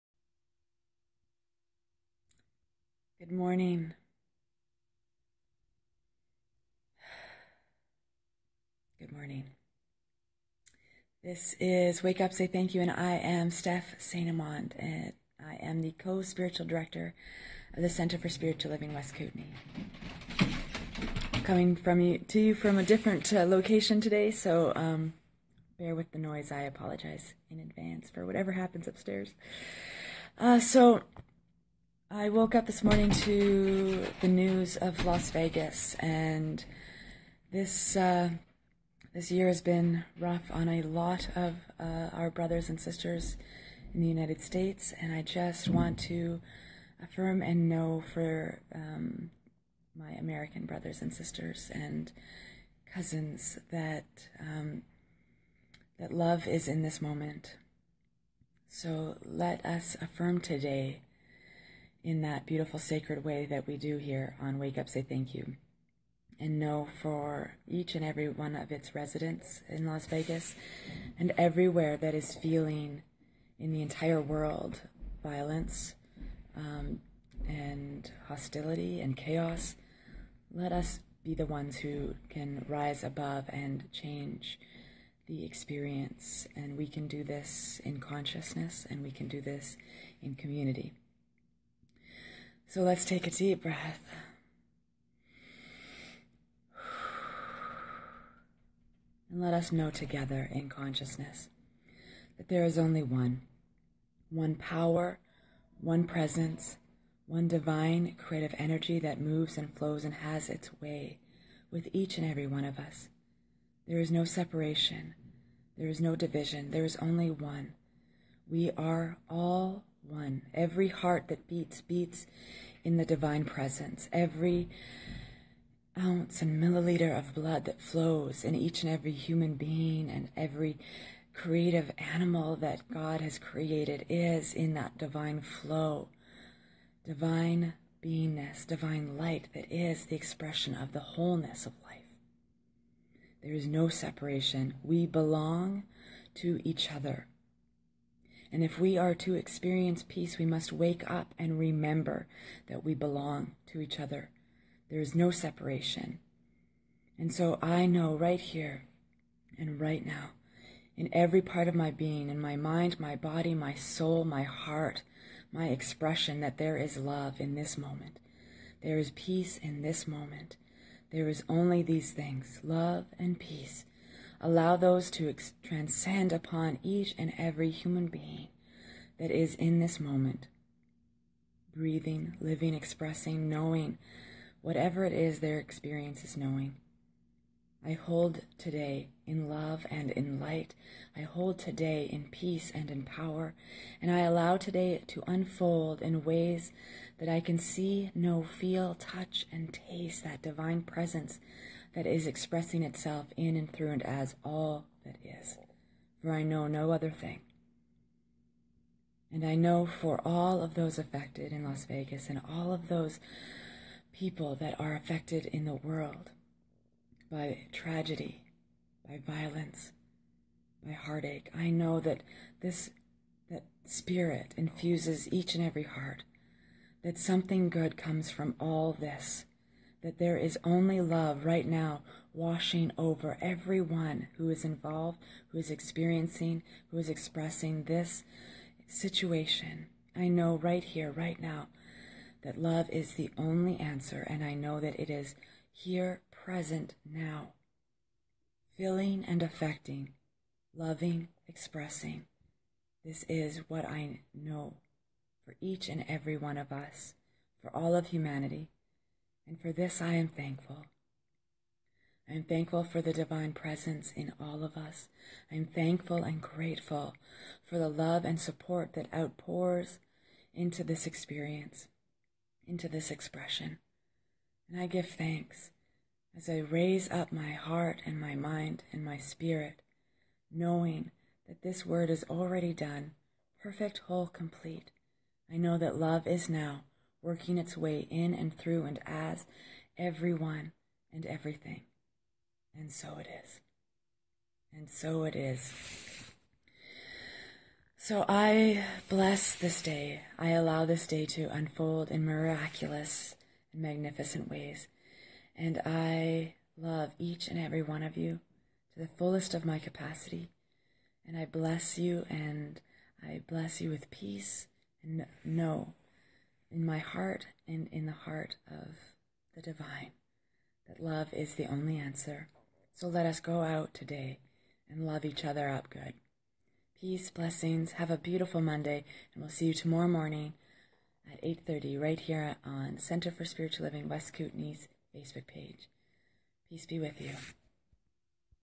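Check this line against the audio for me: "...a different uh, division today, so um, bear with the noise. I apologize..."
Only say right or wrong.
wrong.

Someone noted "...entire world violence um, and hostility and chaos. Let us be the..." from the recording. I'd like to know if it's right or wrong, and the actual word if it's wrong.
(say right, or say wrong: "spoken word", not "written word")
right.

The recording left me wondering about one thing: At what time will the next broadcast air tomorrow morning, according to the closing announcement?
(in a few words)
8:30.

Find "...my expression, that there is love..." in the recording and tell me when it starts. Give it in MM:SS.
02:45.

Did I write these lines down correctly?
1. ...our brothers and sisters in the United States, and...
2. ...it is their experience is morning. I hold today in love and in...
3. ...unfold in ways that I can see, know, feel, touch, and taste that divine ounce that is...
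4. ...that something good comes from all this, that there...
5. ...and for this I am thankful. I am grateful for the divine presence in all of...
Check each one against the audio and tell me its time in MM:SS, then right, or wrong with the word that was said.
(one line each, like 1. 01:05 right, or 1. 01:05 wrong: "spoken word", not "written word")
1. 00:42 right
2. 03:05 wrong: "knowing", not "morning"
3. 03:15 wrong: "presence", not "ounce"
4. 03:47 right
5. 04:19 wrong: "thankful", not "grateful".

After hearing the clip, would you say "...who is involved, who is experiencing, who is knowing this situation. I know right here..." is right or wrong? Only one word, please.
wrong.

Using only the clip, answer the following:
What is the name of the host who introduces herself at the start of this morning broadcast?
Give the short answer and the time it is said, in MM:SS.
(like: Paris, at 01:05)
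Steph St. Amand, at 00:13.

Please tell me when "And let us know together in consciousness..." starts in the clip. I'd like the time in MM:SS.
01:39.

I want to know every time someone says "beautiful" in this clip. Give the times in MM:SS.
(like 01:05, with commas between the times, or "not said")
01:02, 05:28.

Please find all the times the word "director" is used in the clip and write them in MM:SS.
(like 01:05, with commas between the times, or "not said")
00:16.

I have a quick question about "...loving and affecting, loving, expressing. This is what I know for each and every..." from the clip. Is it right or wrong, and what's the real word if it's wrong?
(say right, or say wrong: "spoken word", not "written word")
wrong: "feeling", not "loving".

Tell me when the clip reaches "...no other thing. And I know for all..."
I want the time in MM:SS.
03:26.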